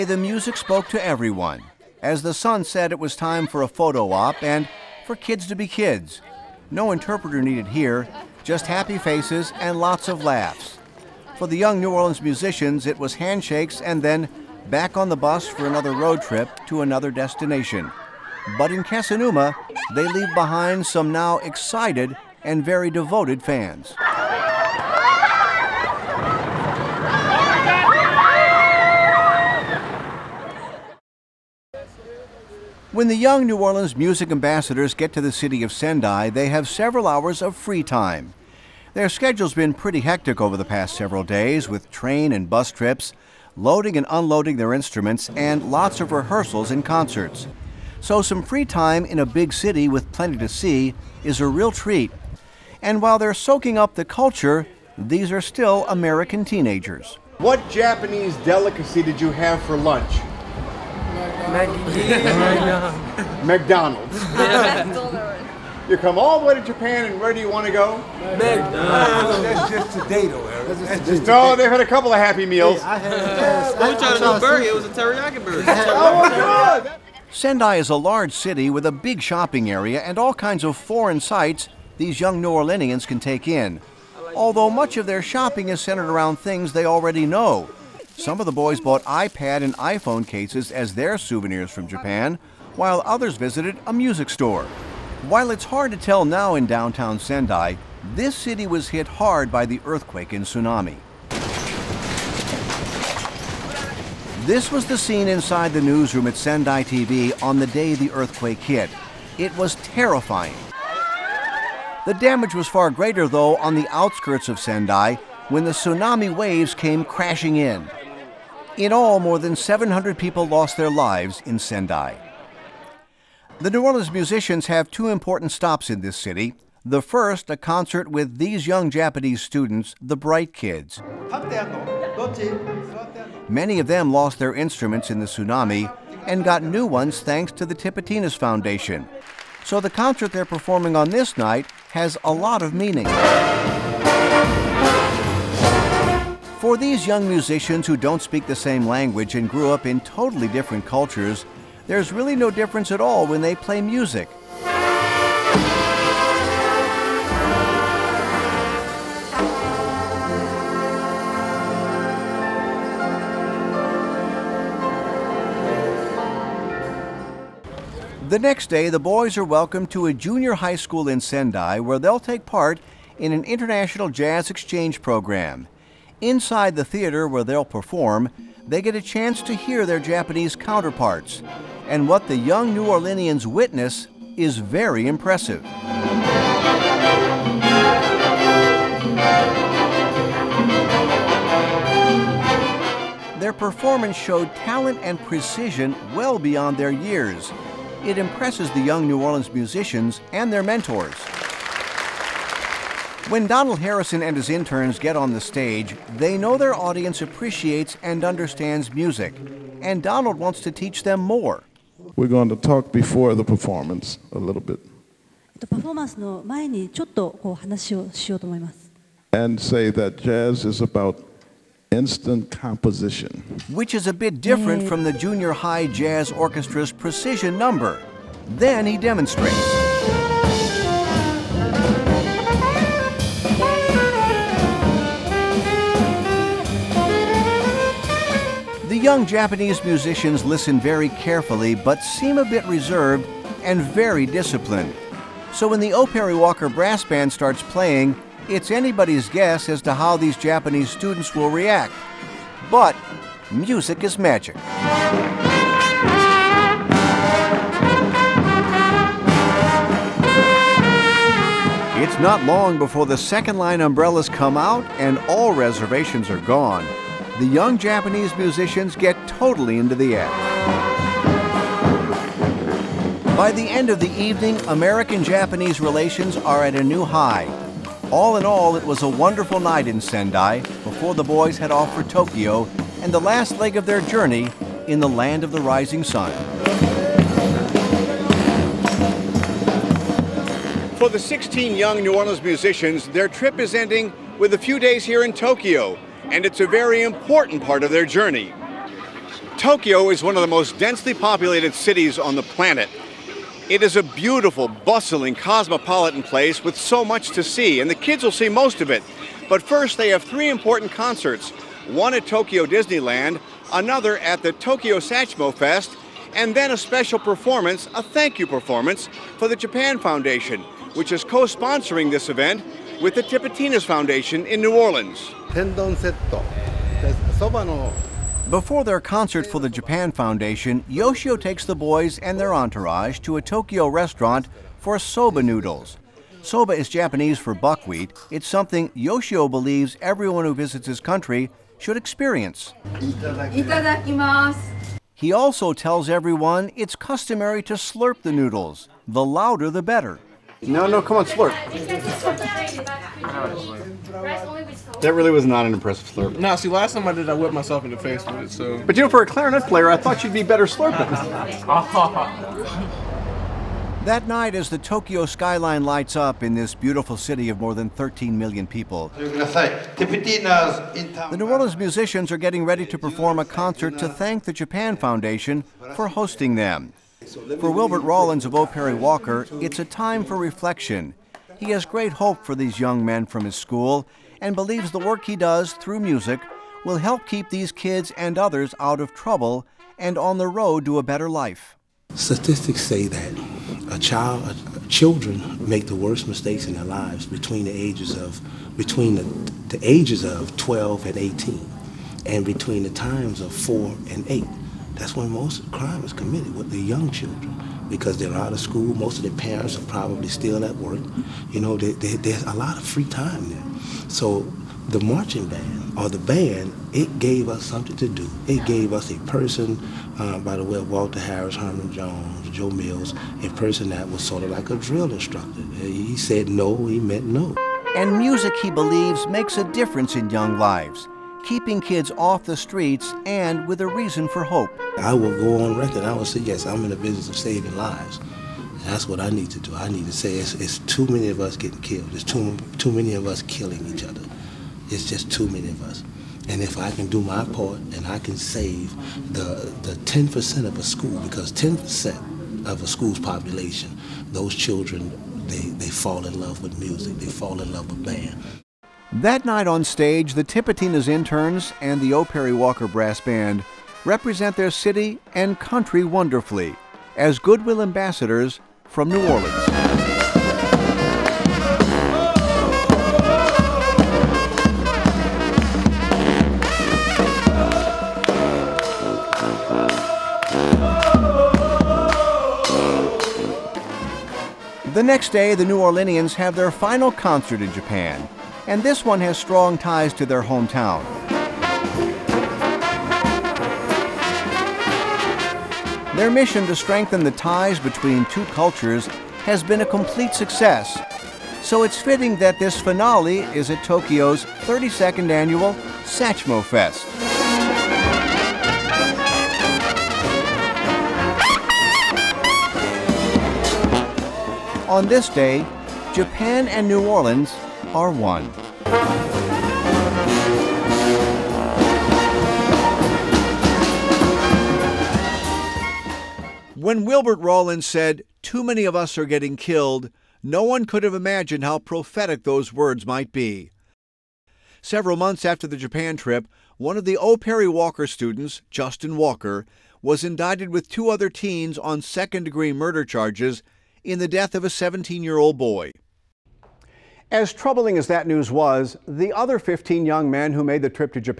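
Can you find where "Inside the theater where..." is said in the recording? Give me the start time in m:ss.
2:56.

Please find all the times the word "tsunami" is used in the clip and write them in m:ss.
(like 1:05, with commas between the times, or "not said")
1:40, 1:55, 2:15.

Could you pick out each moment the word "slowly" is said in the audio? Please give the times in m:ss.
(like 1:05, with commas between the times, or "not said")
not said.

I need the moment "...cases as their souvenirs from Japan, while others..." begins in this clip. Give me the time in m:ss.
1:30.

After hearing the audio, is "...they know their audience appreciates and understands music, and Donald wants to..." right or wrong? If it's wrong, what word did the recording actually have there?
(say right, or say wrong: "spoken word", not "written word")
right.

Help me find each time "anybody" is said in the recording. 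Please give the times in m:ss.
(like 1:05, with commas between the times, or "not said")
4:08.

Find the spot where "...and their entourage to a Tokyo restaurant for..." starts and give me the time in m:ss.
5:32.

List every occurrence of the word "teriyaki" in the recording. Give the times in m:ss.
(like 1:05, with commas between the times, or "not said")
1:14.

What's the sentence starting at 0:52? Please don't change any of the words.
And while they're soaking up the culture, these are still American teenagers.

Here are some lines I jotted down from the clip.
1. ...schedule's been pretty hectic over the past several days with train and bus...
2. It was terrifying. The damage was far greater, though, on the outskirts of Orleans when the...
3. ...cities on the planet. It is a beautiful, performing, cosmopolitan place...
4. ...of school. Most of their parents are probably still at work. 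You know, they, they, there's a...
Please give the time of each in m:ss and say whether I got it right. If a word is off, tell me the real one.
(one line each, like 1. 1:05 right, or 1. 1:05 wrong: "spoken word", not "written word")
1. 0:39 right
2. 1:49 wrong: "Sendai", not "Orleans"
3. 5:01 wrong: "bustling", not "performing"
4. 6:48 right.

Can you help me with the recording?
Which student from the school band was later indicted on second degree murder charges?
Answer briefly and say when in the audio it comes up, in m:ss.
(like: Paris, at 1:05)
Justin Walker, at 8:58.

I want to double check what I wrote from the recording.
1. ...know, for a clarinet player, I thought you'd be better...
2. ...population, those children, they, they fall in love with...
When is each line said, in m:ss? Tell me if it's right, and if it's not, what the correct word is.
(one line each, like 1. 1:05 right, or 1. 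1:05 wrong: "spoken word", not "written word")
1. 5:59 right
2. 7:33 right.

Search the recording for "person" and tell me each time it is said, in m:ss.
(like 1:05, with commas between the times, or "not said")
6:59, 7:03.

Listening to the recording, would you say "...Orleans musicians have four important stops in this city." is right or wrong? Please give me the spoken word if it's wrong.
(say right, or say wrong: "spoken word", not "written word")
wrong: "two", not "four".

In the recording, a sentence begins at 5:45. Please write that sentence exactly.
He also tells everyone it's customary to slurp the noodles.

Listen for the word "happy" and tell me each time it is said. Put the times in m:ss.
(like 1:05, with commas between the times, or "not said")
0:08, 1:12.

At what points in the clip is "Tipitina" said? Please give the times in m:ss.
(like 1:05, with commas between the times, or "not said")
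2:17, 5:23, 7:40.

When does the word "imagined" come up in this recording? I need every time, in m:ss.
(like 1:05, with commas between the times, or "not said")
8:51.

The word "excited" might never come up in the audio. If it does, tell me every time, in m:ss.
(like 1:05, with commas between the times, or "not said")
0:21.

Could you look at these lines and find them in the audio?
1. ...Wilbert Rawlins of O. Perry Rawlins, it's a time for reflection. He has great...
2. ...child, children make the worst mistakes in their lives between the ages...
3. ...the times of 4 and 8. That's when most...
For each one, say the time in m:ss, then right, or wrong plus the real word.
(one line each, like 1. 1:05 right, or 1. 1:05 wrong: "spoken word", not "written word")
1. 6:17 wrong: "Walker", not "Rawlins"
2. 6:33 right
3. 6:42 right.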